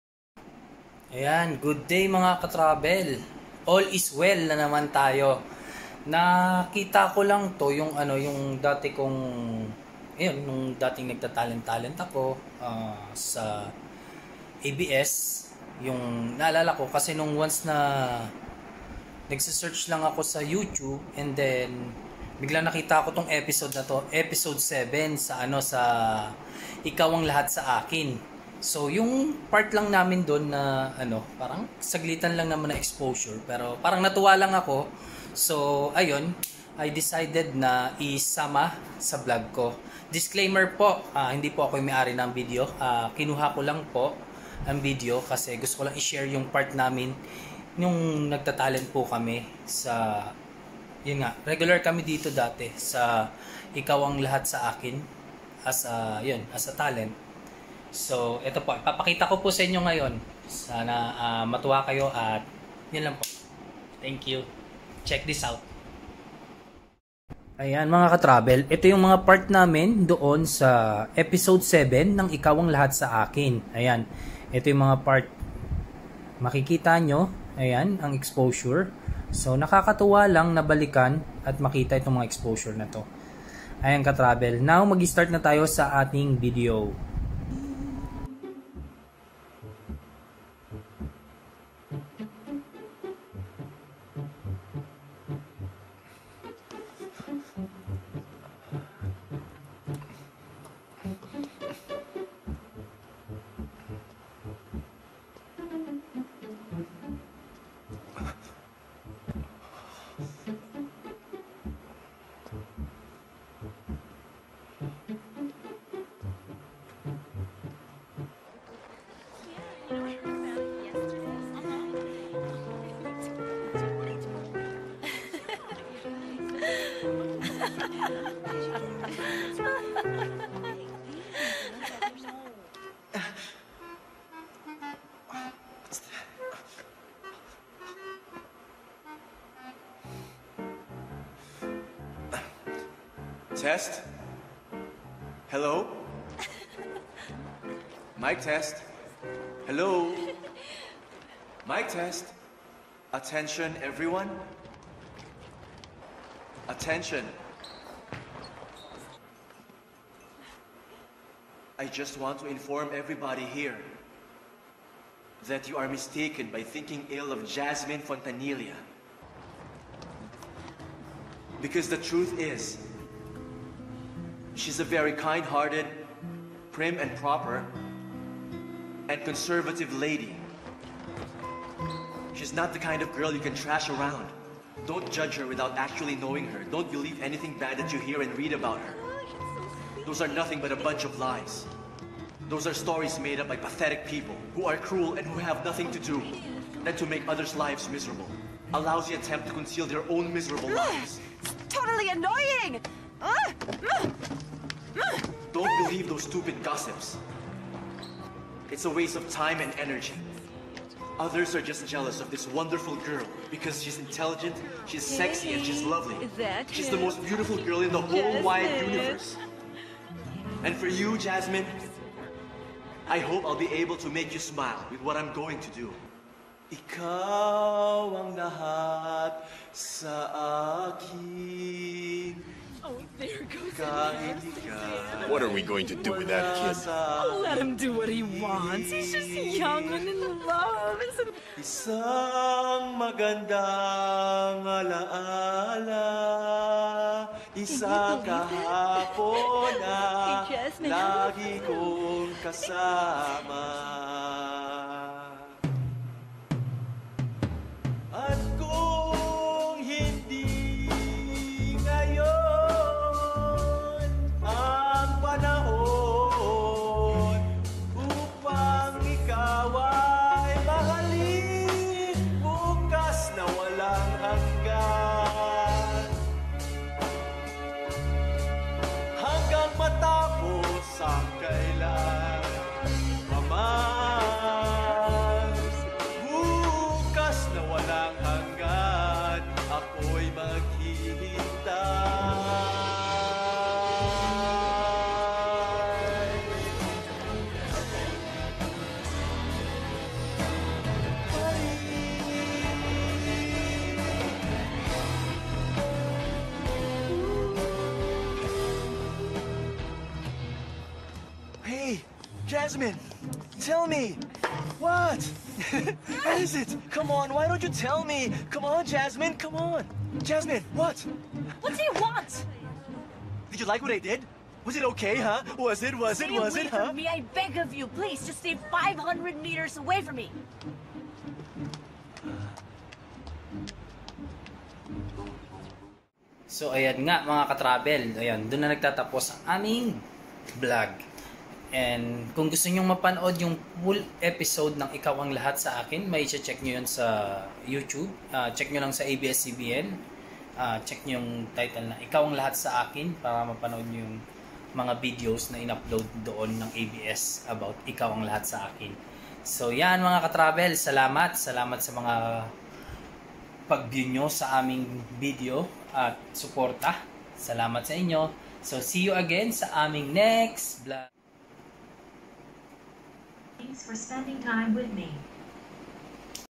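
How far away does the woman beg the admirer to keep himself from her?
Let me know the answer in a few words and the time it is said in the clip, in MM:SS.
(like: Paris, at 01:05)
500 meters, at 05:28.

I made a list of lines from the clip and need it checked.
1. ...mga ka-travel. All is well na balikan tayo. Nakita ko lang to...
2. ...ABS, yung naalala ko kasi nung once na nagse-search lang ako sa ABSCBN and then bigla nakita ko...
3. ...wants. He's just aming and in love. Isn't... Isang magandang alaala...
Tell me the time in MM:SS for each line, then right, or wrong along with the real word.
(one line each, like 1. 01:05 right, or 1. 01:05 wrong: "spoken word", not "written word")
1. 00:02 wrong: "naman", not "balikan"
2. 00:14 wrong: "YouTube", not "ABSCBN"
3. 03:58 wrong: "young", not "aming".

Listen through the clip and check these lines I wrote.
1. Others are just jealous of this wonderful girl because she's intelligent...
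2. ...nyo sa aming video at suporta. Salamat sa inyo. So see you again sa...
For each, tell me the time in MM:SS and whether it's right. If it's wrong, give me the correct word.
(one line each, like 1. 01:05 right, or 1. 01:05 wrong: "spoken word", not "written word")
1. 03:31 right
2. 06:04 right.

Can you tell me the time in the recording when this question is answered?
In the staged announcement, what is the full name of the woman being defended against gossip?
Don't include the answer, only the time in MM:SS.
02:47.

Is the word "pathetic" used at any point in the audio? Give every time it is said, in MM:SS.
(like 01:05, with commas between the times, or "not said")
03:13.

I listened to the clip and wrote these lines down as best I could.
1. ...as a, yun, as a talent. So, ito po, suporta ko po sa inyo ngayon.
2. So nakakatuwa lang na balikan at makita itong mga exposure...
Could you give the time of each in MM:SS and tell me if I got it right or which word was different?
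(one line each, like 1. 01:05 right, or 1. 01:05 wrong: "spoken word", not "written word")
1. 00:55 wrong: "ipapakita", not "suporta"
2. 01:19 right.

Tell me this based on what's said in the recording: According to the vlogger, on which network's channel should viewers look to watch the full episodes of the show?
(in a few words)
ABS-CBN.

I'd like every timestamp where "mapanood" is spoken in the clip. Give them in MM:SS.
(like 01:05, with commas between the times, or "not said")
05:42, 05:53.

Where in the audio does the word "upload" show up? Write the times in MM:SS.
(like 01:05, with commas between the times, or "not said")
05:55.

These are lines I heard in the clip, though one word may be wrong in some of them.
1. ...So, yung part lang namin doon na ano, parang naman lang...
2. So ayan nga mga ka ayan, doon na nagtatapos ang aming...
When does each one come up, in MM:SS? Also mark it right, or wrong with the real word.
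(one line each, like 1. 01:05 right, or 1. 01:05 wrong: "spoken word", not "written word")
1. 00:28 wrong: "saglitan", not "naman"
2. 05:36 right.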